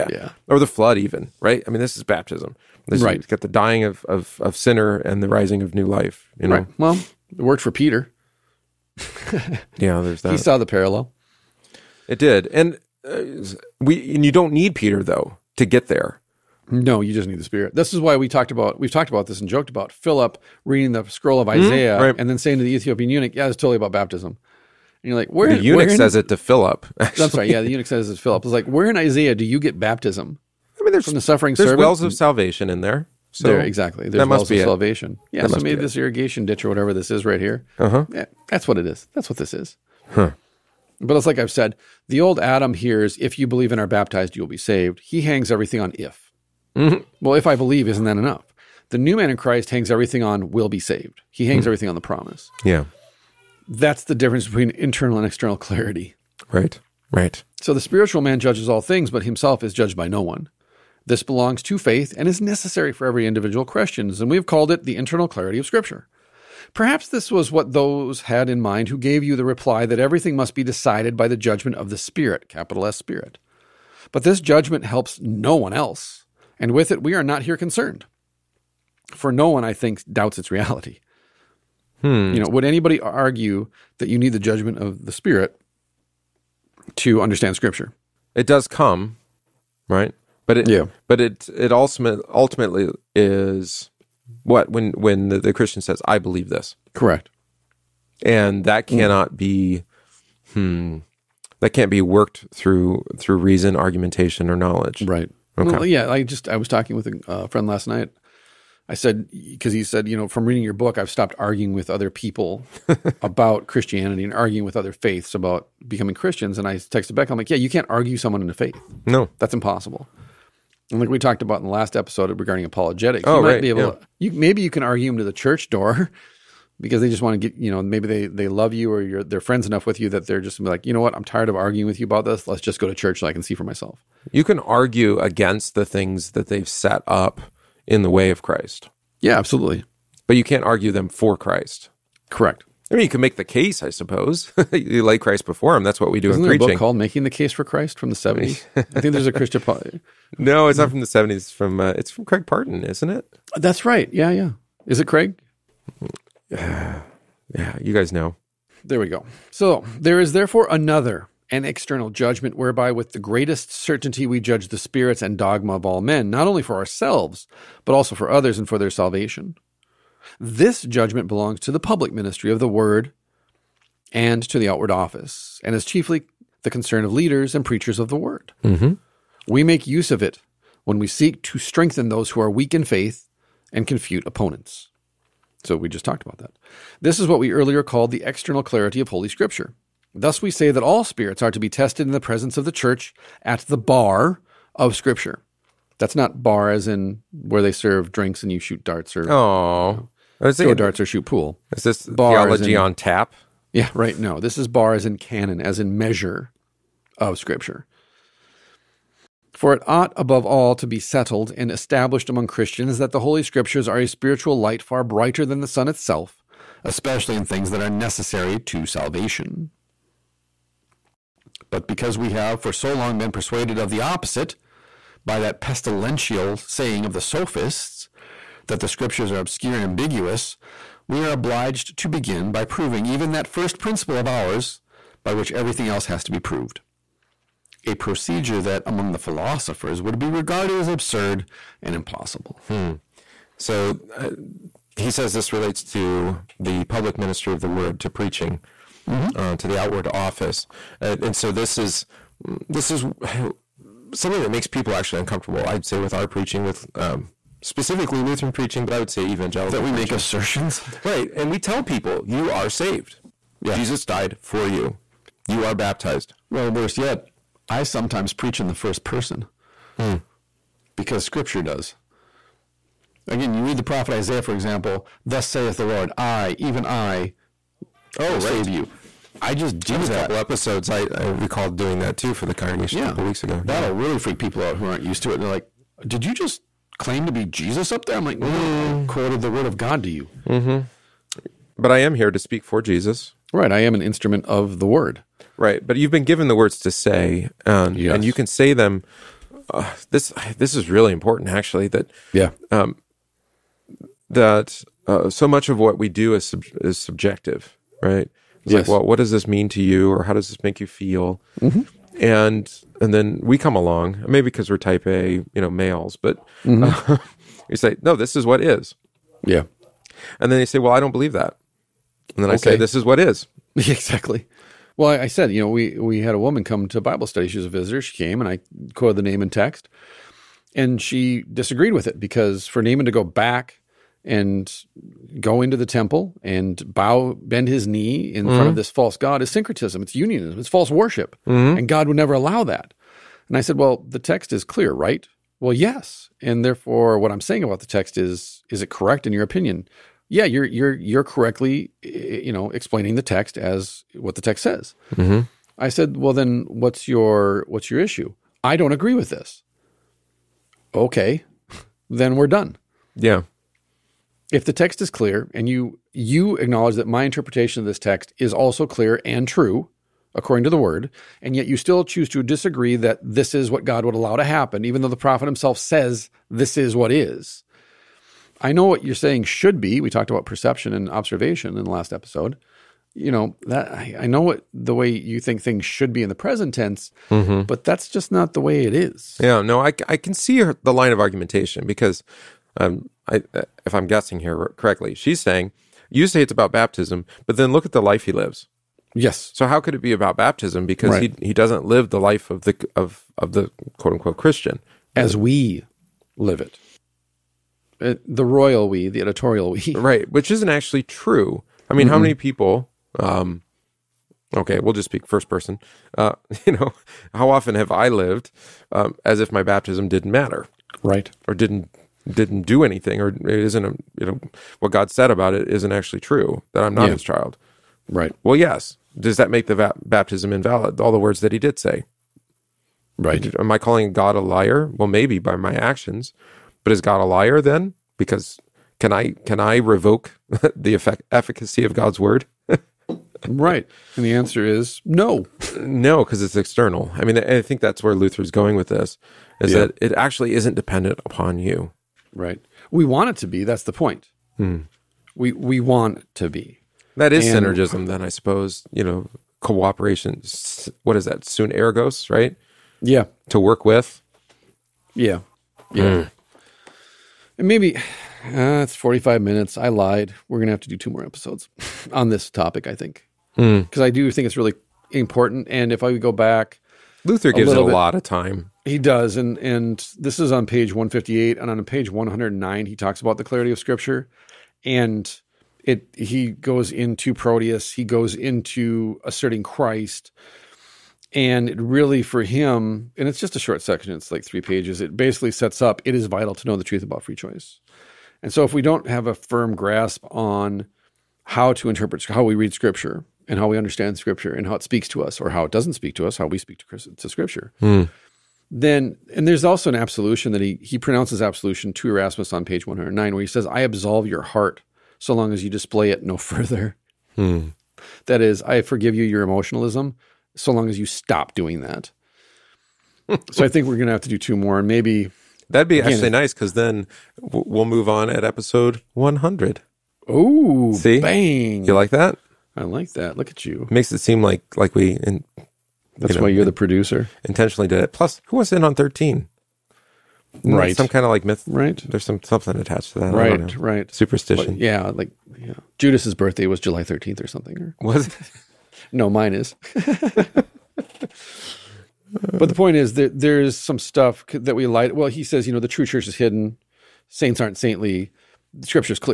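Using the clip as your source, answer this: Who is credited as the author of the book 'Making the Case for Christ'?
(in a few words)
Craig Parton.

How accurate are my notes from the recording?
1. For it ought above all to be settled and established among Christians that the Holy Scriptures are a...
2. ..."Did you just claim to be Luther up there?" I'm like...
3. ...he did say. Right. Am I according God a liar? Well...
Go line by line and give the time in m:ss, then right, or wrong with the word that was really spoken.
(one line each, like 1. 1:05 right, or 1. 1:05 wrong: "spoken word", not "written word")
1. 3:29 right
2. 4:46 wrong: "Jesus", not "Luther"
3. 7:11 wrong: "calling", not "according".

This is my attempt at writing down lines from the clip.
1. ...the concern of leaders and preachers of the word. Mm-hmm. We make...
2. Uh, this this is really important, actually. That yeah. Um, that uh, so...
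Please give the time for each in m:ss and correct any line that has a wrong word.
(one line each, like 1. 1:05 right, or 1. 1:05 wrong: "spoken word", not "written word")
1. 2:56 right
2. 4:59 right.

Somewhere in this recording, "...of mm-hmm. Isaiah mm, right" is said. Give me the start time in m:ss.
0:21.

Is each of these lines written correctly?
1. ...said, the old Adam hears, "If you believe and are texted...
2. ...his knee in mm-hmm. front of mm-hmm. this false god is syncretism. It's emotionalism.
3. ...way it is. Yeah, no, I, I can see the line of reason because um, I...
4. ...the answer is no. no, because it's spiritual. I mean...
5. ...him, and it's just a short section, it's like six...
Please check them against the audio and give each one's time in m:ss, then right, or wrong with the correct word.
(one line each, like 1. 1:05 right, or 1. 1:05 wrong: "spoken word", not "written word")
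1. 0:41 wrong: "baptized", not "texted"
2. 5:37 wrong: "unionism", not "emotionalism"
3. 6:28 wrong: "argumentation", not "reason"
4. 7:24 wrong: "external", not "spiritual"
5. 8:12 wrong: "three", not "six".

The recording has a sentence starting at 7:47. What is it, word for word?
And maybe uh, it's forty-five minutes.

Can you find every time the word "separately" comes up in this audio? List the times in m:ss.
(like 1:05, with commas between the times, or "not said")
not said.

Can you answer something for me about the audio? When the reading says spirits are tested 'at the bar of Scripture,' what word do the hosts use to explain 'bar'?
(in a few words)
canon.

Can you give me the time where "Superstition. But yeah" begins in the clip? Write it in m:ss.
9:04.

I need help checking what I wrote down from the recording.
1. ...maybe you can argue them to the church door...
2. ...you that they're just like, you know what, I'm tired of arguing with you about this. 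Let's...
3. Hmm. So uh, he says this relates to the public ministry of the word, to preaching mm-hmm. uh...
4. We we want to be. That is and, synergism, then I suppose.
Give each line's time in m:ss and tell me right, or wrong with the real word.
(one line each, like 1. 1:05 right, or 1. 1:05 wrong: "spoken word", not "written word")
1. 2:04 right
2. 2:10 right
3. 4:02 right
4. 7:35 right.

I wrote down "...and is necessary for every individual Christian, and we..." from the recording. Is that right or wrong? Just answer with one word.
right.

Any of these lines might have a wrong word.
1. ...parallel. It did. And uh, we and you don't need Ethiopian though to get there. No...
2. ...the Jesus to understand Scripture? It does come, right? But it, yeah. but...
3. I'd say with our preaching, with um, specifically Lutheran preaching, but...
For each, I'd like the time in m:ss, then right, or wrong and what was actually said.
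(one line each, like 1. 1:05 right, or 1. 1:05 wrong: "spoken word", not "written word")
1. 0:10 wrong: "Peter", not "Ethiopian"
2. 1:25 wrong: "Spirit", not "Jesus"
3. 4:15 right.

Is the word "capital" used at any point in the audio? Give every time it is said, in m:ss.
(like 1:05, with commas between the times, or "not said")
1:12.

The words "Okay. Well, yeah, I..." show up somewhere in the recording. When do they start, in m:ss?
1:45.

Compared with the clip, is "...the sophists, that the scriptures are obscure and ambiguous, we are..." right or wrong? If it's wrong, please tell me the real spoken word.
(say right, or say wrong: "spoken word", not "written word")
right.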